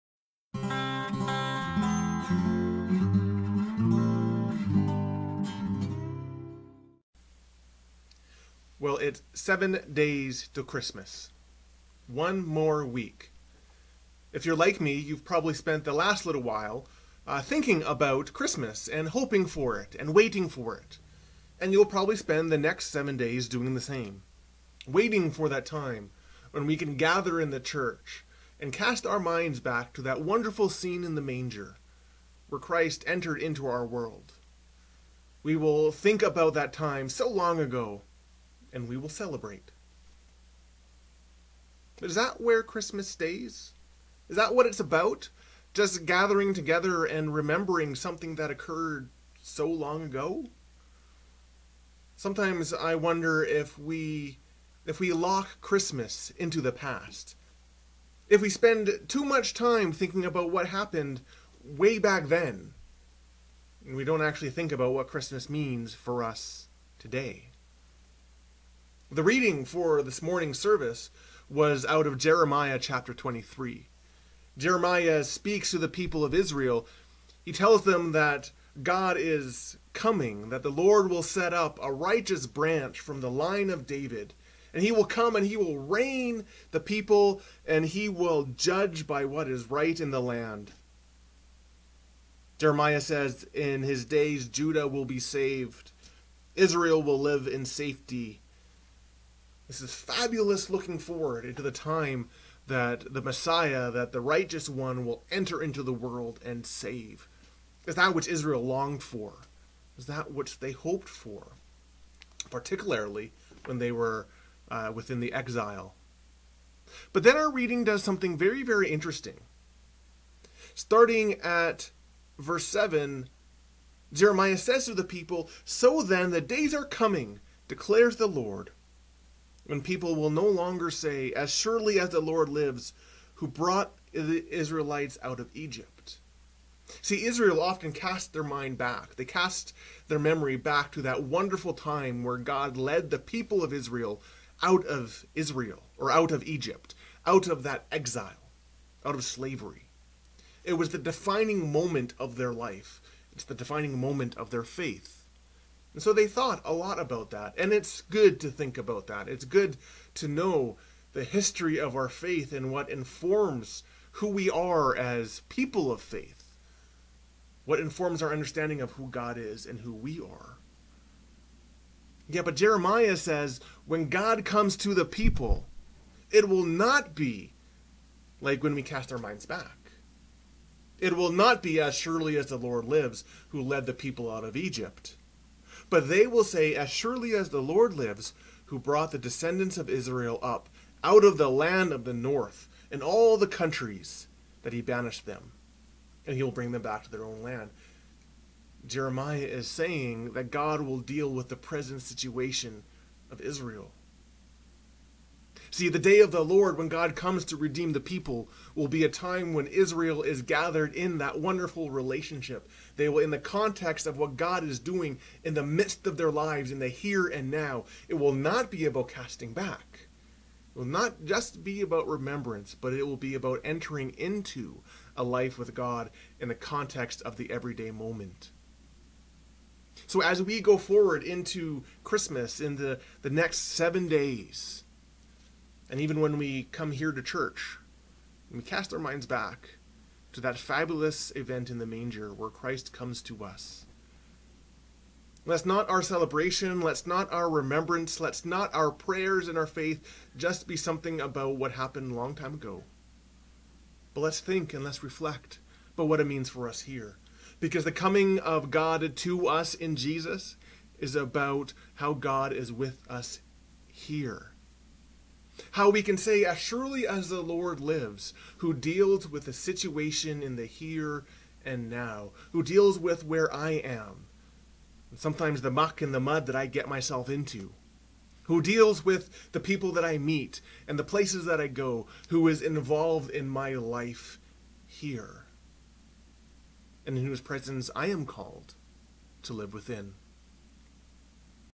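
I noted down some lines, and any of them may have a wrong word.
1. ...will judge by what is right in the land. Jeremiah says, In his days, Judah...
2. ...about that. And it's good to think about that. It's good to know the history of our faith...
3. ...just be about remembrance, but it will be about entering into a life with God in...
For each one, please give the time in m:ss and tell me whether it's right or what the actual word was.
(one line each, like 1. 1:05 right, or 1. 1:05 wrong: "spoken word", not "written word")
1. 1:28 right
2. 2:36 right
3. 3:41 right.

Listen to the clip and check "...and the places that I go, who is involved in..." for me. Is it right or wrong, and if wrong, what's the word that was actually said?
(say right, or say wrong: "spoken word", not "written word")
right.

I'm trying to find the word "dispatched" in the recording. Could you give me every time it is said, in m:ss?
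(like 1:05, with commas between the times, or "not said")
not said.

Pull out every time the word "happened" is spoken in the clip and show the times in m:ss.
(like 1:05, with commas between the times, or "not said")
1:00, 4:11.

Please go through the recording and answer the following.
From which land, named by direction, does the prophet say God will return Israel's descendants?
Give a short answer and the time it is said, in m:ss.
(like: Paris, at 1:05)
the land of the north, at 3:11.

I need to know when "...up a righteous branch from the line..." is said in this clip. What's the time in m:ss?
1:21.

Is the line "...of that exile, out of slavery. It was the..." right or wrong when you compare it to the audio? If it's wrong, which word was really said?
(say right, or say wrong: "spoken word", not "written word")
right.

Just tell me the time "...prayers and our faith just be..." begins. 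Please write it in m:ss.
4:08.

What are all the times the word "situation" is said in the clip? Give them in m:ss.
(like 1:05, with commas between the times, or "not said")
3:22, 4:29.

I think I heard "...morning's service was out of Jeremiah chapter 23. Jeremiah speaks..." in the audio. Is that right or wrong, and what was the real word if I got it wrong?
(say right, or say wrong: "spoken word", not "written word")
right.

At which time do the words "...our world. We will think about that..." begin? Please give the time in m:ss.
0:33.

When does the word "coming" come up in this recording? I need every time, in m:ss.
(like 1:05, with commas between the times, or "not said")
1:19, 2:06, 4:17.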